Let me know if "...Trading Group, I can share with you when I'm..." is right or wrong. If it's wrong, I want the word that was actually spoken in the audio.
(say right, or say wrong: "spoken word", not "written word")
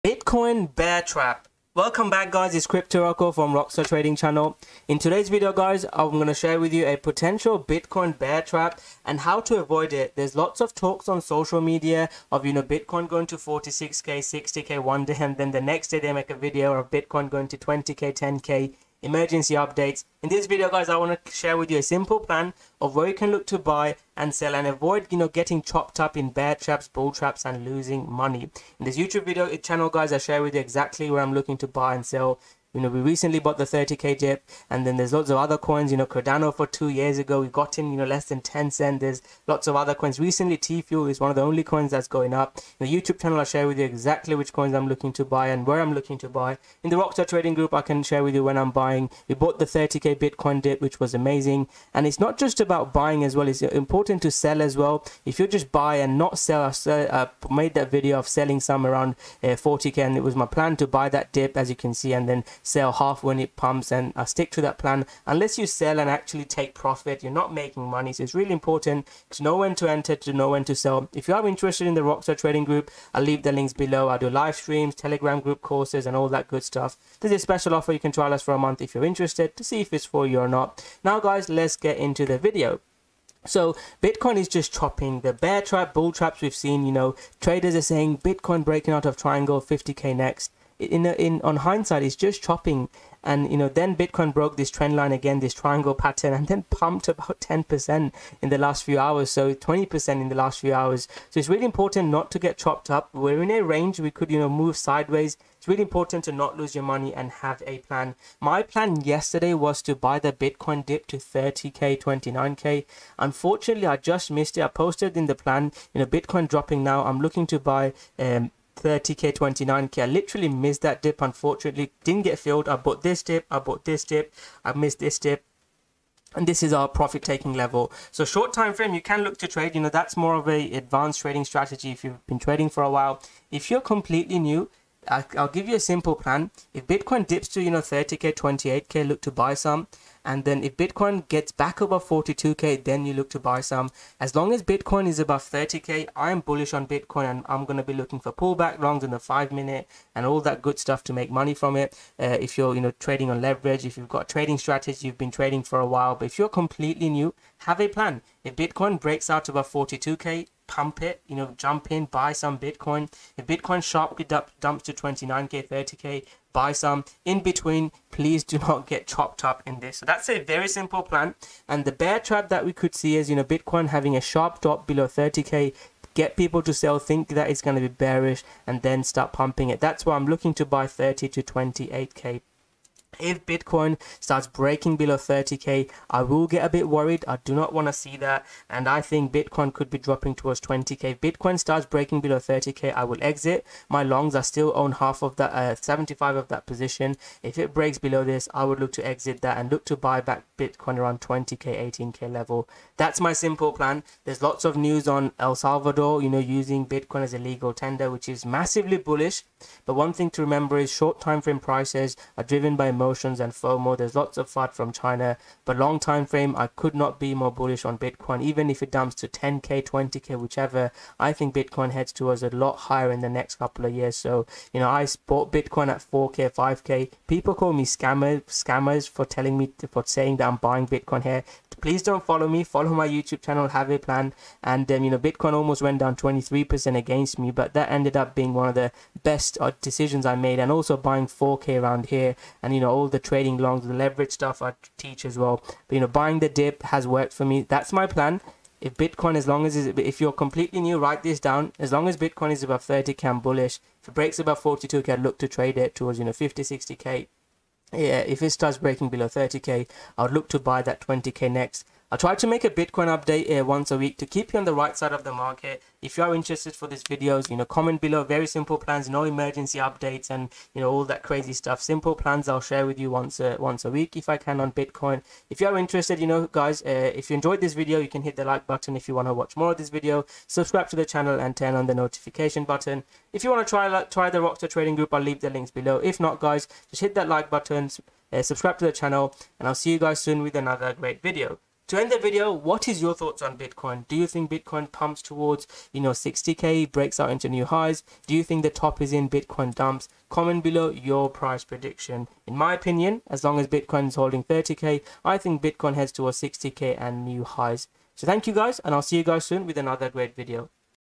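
right.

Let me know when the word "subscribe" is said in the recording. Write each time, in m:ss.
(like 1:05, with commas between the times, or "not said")
4:40, 4:48.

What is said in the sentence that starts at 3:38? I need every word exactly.
Even if it dumps to 10k, 20k, whichever, I think Bitcoin heads towards a lot higher in the next couple of years.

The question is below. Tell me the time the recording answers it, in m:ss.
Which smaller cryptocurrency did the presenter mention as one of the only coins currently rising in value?
0:40.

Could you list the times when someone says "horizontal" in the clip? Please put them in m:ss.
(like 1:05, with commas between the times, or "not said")
not said.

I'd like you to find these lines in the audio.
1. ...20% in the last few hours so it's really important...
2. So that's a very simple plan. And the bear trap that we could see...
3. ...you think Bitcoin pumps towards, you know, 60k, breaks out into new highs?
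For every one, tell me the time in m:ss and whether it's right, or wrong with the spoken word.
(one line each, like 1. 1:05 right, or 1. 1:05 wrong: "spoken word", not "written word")
1. 1:39 right
2. 2:49 right
3. 4:54 right.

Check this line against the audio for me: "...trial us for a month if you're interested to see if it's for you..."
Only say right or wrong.
right.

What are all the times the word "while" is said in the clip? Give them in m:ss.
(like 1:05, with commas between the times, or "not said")
2:12, 2:35.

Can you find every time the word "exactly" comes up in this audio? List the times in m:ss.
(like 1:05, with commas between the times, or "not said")
0:30, 0:43.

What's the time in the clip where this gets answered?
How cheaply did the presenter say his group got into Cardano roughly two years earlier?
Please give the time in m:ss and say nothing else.
0:38.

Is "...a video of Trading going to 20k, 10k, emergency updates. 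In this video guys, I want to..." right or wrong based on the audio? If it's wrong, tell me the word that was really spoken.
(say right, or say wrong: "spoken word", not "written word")
wrong: "Bitcoin", not "Trading".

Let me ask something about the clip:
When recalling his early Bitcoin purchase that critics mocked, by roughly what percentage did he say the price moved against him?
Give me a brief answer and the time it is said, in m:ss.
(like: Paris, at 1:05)
23%, at 3:56.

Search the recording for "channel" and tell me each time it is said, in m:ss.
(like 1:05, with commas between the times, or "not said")
0:04, 0:29, 0:43, 3:53, 4:41, 4:48.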